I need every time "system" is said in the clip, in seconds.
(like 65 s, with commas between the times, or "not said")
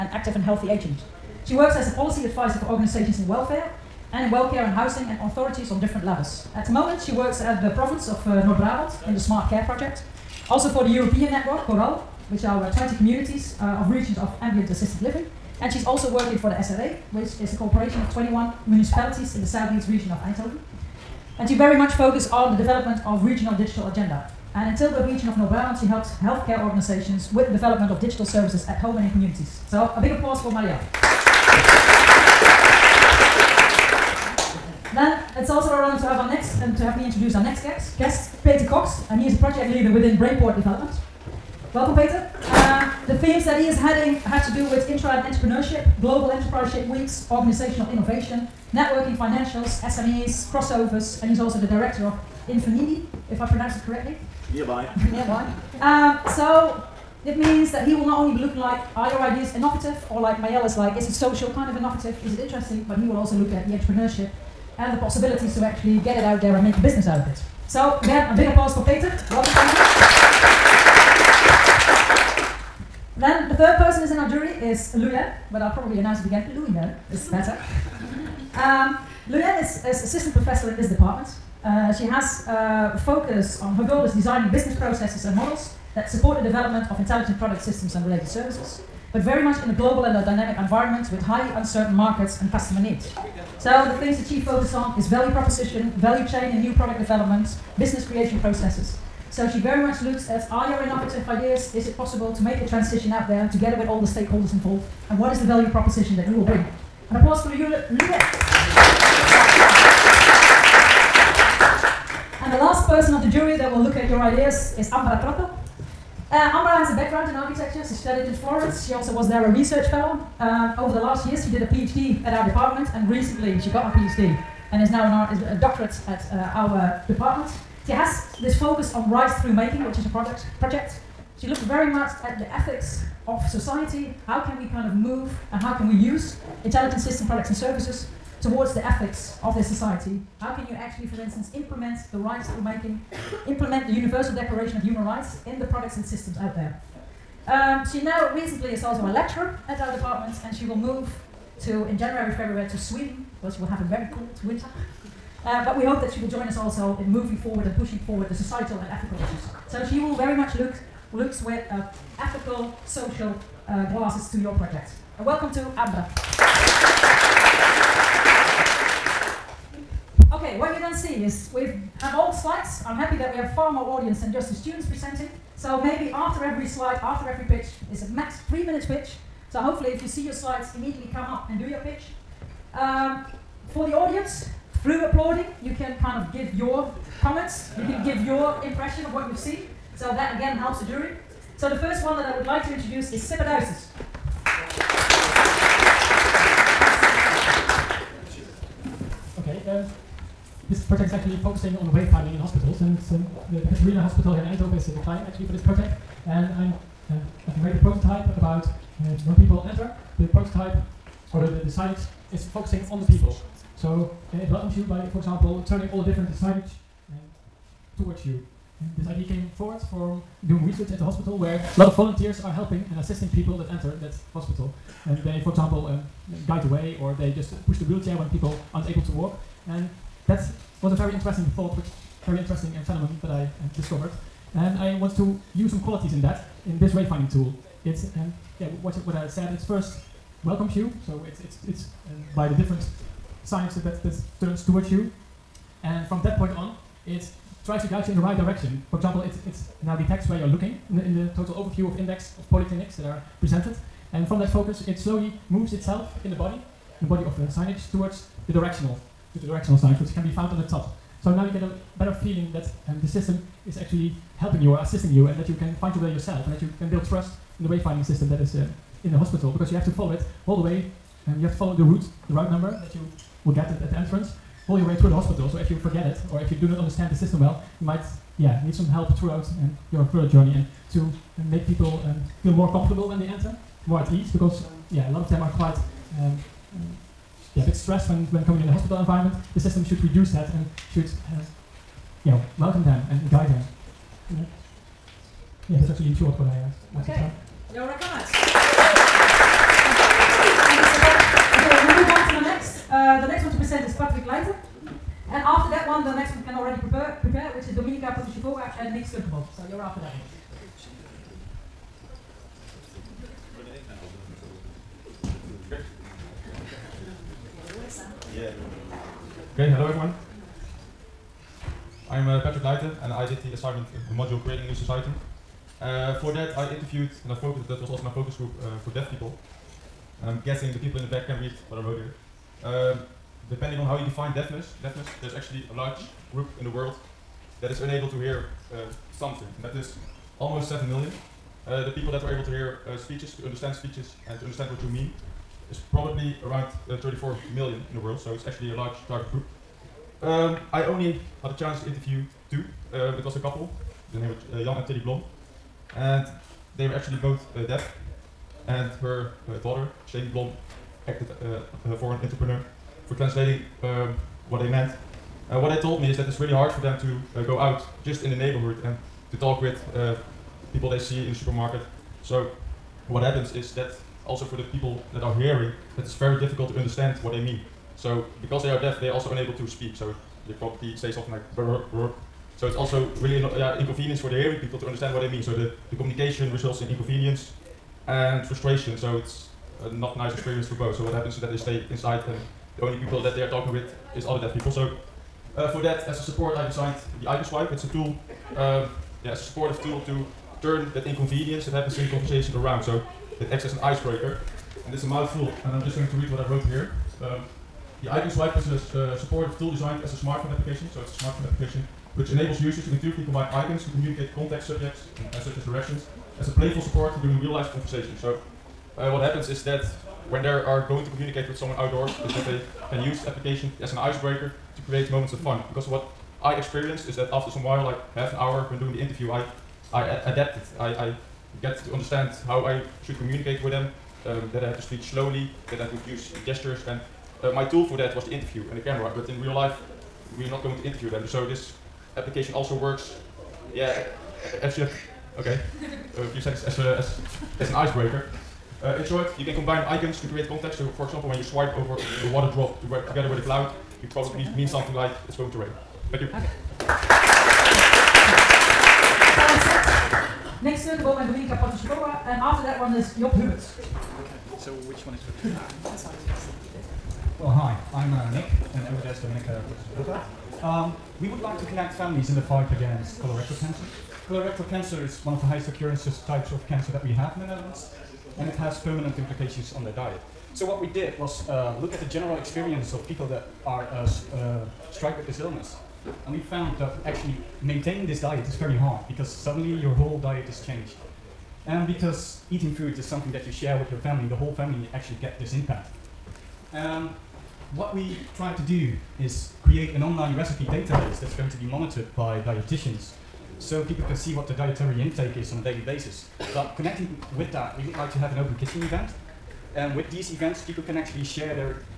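87 s, 136 s, 146 s, 263 s, 268 s, 277 s, 289 s.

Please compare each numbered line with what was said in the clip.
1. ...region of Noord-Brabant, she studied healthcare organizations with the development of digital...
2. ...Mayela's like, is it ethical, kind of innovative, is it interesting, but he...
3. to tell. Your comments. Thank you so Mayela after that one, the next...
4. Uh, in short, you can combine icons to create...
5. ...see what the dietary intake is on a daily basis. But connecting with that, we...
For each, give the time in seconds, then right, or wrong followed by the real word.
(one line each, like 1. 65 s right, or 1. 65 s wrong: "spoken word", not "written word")
1. 25 s wrong: "helped", not "studied"
2. 60 s wrong: "social", not "ethical"
3. 297 s wrong: "And", not "Mayela"
4. 448 s right
5. 504 s right.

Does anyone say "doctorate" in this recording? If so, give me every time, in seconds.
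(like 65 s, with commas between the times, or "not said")
125 s.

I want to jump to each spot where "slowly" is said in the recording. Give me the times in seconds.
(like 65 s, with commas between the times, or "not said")
254 s, 435 s.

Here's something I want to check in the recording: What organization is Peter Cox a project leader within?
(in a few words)
Brainport Development.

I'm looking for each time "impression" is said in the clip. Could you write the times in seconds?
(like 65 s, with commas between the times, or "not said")
188 s.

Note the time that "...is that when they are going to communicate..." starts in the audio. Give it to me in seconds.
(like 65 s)
419 s.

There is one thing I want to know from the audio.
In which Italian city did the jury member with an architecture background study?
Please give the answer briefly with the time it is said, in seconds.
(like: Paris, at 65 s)
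Florence, at 118 s.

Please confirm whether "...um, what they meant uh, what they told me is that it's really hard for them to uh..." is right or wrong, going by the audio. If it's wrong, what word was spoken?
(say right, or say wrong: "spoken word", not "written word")
right.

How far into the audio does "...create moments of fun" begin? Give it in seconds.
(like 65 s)
424 s.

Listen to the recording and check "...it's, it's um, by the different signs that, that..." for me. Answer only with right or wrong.
right.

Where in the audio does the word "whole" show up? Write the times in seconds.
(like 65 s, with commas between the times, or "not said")
489 s, 494 s.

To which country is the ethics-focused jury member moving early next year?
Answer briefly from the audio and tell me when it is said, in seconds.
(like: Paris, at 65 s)
Sweden, at 152 s.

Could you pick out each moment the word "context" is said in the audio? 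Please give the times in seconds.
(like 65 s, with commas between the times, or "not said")
414 s, 450 s.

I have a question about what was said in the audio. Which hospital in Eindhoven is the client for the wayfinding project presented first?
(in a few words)
Catharina Hospital.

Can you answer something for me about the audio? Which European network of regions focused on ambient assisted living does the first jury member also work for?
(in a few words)
CORAL.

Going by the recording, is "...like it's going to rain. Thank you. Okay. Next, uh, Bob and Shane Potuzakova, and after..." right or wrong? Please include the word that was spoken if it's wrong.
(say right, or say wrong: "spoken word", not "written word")
wrong: "Dominika", not "Shane".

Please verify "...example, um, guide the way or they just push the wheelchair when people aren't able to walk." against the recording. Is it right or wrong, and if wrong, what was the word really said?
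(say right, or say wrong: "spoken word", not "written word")
right.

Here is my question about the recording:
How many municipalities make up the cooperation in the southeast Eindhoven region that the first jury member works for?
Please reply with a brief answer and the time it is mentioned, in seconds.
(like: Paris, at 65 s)
21, at 18 s.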